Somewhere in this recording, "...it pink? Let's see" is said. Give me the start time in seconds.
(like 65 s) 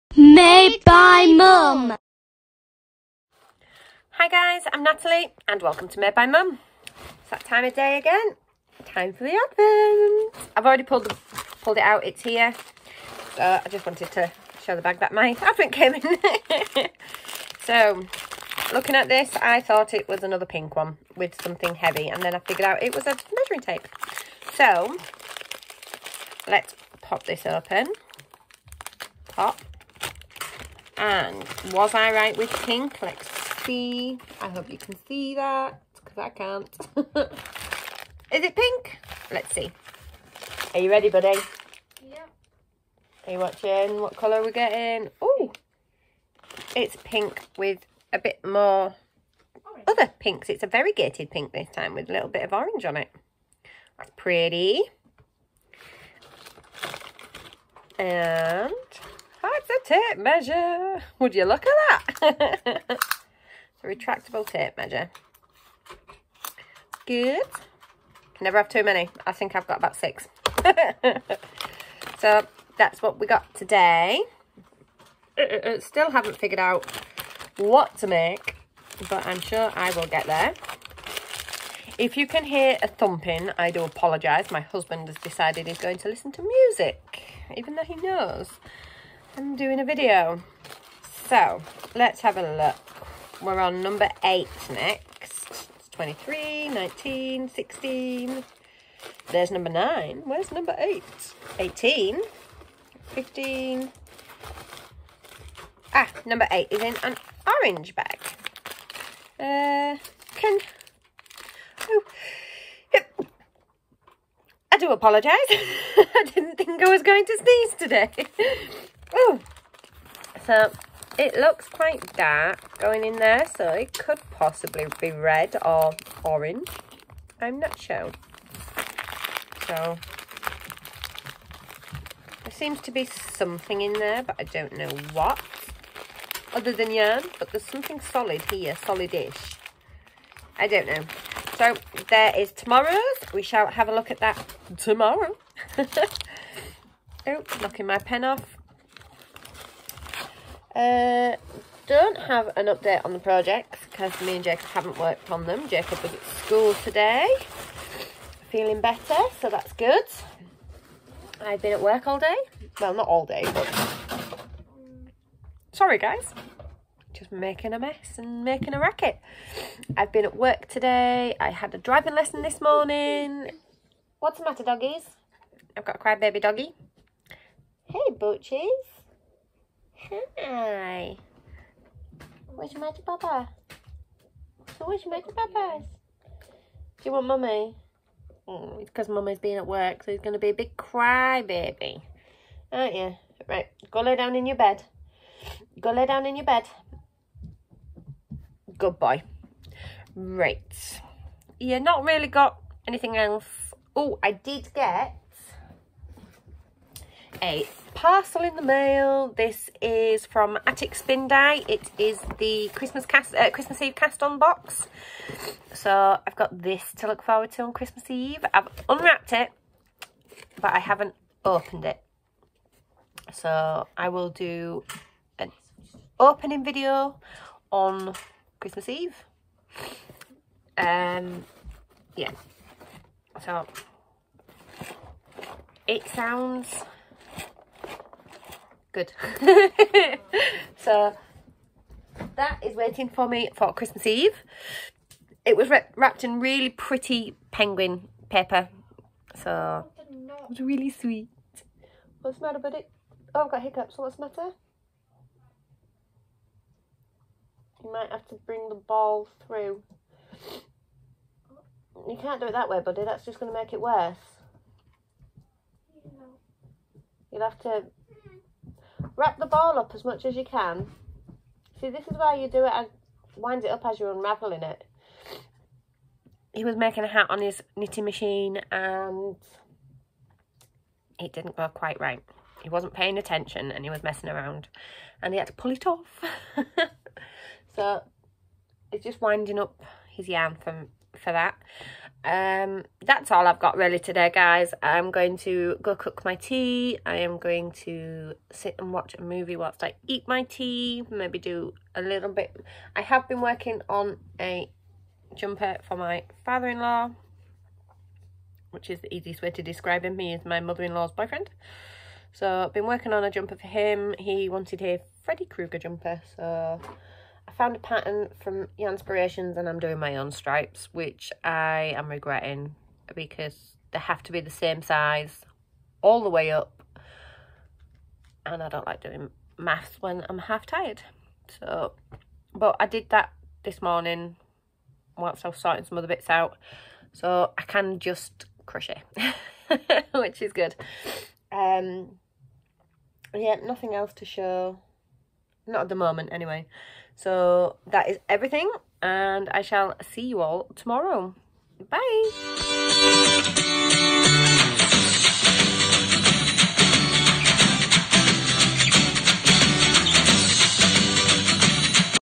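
38 s.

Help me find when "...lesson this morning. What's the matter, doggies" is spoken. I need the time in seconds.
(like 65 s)
172 s.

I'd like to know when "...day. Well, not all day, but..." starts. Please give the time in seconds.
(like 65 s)
162 s.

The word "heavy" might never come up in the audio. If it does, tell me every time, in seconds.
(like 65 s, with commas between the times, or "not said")
21 s.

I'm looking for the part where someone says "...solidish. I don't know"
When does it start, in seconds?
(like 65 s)
138 s.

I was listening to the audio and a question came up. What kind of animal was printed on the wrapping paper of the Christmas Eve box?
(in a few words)
penguin.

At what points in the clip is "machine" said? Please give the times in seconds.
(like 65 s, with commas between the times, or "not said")
278 s.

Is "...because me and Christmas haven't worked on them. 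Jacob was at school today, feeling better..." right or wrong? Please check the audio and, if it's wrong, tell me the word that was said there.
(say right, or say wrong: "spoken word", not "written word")
wrong: "Jacob", not "Christmas".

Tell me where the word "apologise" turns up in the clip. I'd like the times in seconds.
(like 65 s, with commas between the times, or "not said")
83 s, 114 s.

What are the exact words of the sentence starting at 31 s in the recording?
And was I right with pink?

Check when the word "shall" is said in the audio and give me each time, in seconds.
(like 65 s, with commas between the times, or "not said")
143 s, 349 s.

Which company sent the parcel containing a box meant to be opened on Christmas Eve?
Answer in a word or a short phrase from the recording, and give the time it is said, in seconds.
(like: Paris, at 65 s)
Attic Spin Day, at 210 s.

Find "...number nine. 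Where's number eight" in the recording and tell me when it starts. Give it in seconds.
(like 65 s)
99 s.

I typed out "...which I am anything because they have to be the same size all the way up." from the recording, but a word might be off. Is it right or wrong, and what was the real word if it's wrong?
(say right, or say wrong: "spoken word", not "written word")
wrong: "regretting", not "anything".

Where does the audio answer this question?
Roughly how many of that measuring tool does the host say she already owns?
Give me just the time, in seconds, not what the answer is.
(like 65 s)
69 s.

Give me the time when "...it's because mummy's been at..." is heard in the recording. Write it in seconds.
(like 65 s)
188 s.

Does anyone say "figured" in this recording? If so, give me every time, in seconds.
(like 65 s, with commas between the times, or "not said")
22 s, 76 s.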